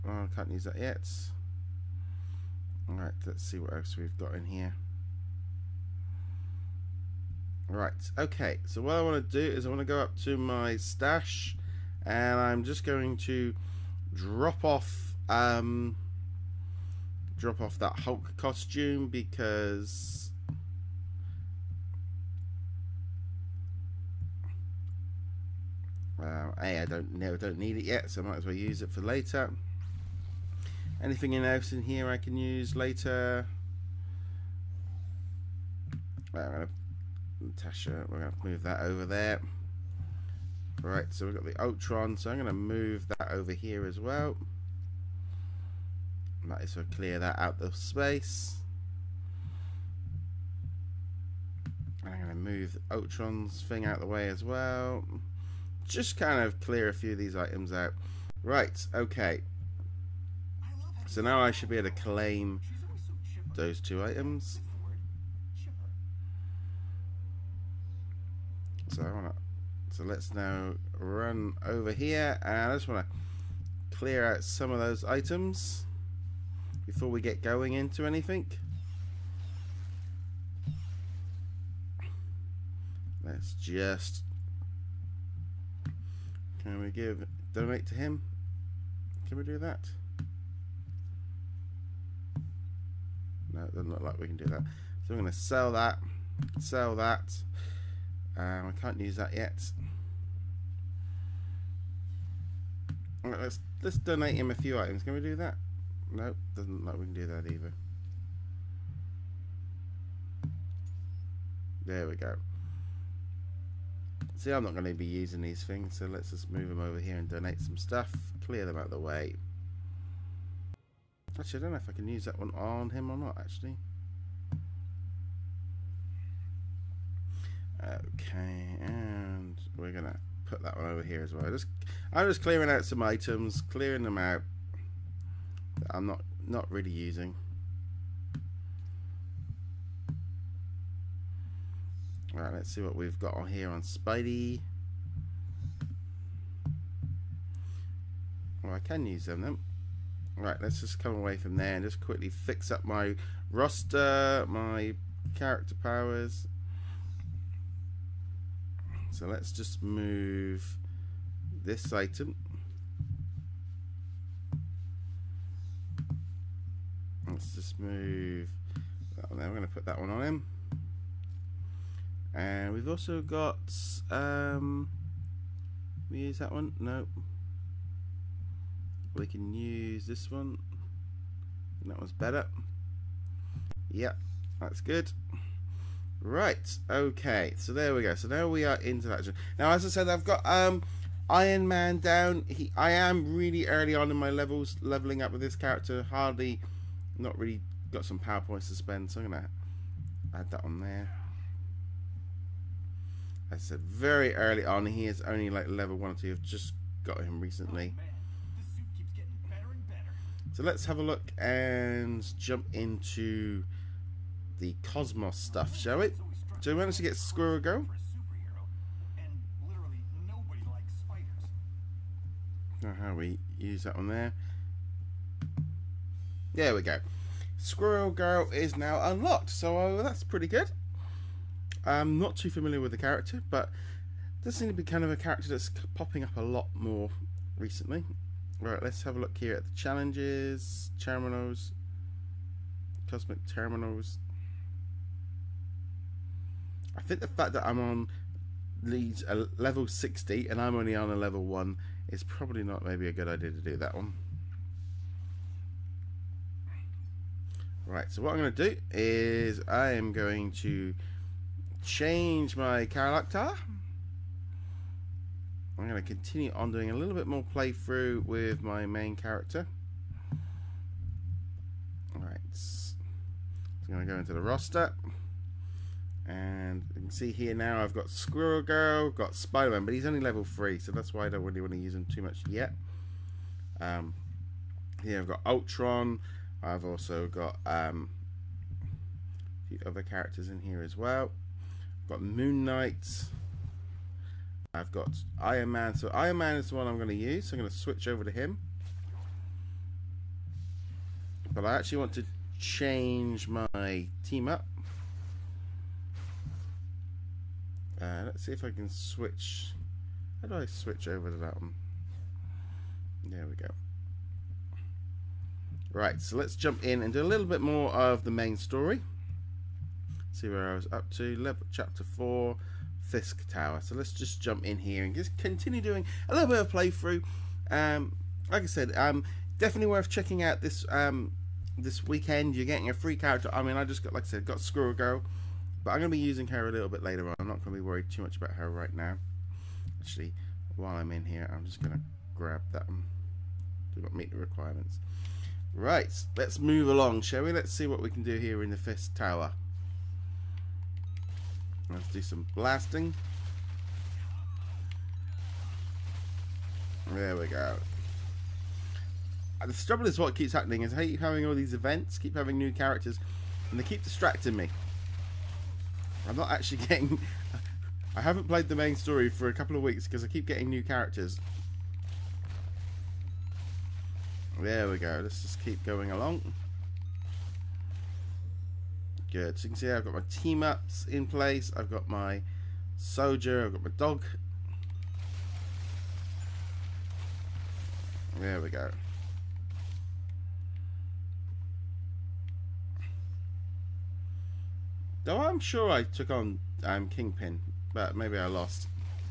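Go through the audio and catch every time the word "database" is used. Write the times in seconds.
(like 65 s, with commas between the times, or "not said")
not said.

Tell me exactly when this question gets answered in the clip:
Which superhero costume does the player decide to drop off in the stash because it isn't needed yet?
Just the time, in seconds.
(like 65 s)
17 s.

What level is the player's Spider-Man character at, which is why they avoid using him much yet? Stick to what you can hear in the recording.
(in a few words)
3.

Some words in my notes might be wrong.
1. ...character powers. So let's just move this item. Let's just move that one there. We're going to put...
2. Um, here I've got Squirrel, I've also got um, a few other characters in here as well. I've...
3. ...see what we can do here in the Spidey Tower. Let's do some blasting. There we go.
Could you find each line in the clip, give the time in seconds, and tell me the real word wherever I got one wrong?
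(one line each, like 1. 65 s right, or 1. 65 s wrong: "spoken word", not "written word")
1. 155 s right
2. 283 s wrong: "Ultron", not "Squirrel"
3. 347 s wrong: "Fisk", not "Spidey".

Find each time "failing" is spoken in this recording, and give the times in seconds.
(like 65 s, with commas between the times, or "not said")
not said.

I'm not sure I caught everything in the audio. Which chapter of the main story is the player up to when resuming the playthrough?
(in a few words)
Chapter 4.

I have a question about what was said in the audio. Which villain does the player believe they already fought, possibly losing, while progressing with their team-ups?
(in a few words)
Kingpin.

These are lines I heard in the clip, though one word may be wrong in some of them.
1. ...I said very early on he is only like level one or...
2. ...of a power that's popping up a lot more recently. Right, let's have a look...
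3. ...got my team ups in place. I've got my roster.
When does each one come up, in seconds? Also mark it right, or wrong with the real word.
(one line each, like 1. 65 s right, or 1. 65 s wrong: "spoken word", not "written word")
1. 203 s right
2. 235 s wrong: "character", not "power"
3. 380 s wrong: "soldier", not "roster".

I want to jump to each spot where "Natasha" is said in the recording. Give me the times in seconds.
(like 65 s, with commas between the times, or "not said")
37 s.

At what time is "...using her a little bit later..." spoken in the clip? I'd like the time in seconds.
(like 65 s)
336 s.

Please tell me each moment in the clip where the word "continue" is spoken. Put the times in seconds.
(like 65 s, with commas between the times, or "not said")
266 s, 325 s.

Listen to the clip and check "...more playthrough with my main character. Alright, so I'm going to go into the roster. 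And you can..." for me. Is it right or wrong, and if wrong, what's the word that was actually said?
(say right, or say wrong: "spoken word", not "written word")
right.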